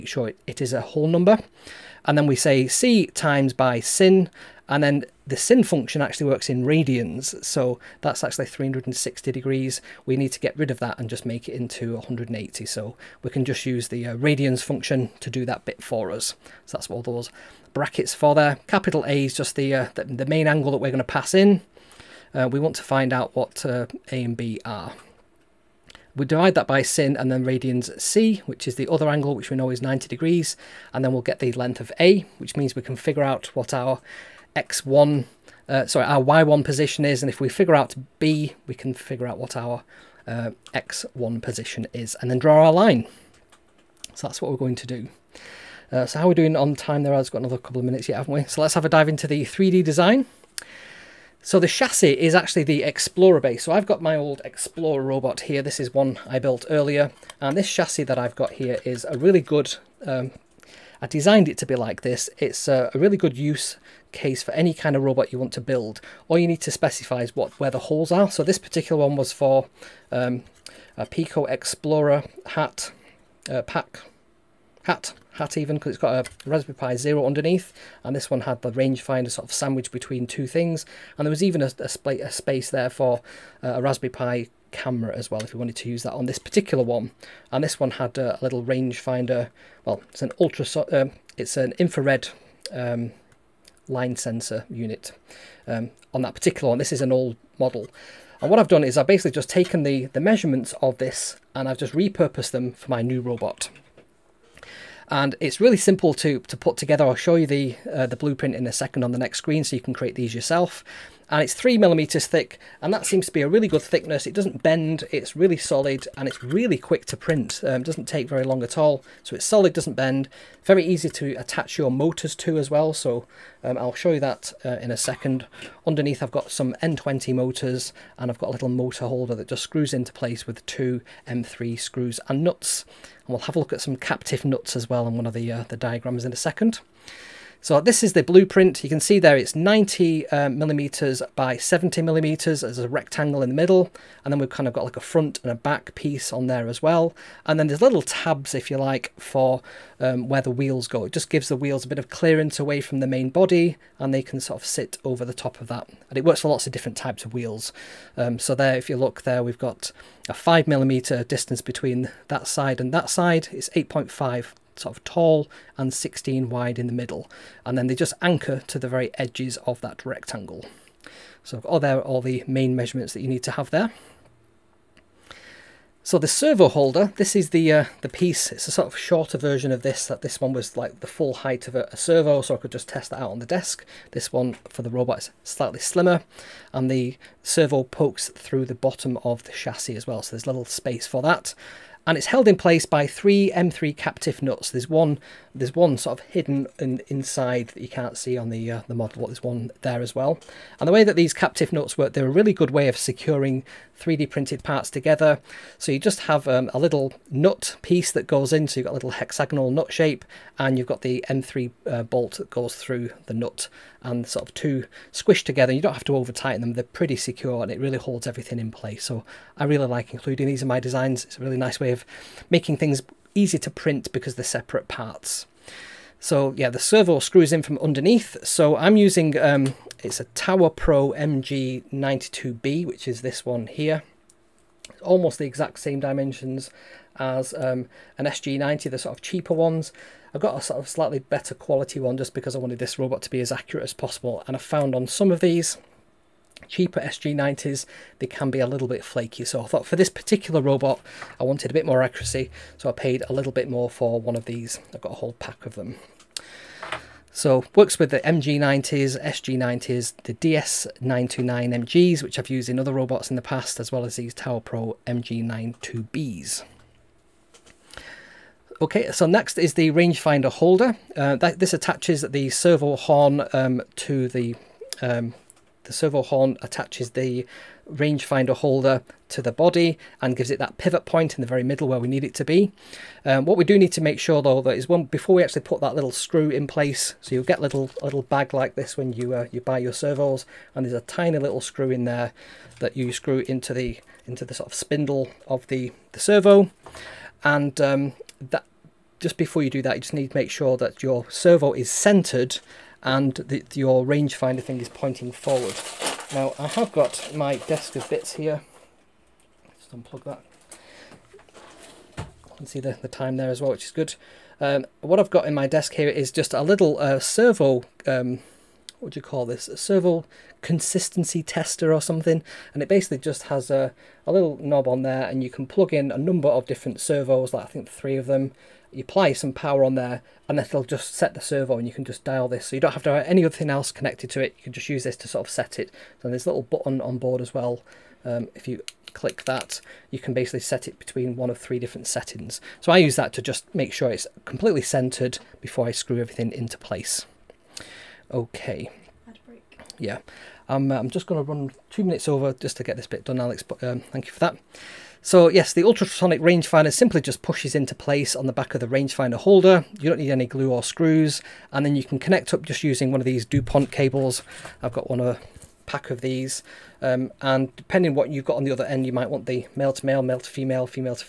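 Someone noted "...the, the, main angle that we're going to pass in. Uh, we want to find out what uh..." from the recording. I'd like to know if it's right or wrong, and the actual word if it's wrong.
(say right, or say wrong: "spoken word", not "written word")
right.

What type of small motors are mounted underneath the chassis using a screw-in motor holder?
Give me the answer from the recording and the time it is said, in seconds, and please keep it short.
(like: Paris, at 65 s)
N20 motors, at 126 s.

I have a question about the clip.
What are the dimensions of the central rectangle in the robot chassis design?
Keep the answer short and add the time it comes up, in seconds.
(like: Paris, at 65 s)
90 by 70 millimeters, at 139 s.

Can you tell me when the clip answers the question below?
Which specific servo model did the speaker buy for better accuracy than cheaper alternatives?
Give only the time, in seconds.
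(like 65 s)
230 s.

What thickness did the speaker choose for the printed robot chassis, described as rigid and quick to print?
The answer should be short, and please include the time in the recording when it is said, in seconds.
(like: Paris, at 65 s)
3 millimeters, at 111 s.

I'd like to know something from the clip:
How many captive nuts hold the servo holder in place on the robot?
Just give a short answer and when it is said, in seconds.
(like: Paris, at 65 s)
3, at 193 s.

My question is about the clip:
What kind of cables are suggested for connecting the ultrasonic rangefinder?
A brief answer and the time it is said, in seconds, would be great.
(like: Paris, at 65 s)
DuPont cables, at 363 s.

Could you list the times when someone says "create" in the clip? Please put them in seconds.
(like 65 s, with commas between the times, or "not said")
109 s.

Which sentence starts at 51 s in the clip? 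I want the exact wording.
So the chassis is actually the Explorer base.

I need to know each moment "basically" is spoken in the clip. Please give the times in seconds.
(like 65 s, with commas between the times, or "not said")
99 s, 322 s, 340 s.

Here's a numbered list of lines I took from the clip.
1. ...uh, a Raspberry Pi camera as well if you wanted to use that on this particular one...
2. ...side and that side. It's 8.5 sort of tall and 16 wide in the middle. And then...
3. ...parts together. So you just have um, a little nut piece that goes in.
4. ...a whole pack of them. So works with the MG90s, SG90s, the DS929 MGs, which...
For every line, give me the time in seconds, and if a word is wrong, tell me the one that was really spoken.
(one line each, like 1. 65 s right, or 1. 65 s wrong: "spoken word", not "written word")
1. 83 s right
2. 162 s right
3. 204 s right
4. 255 s right.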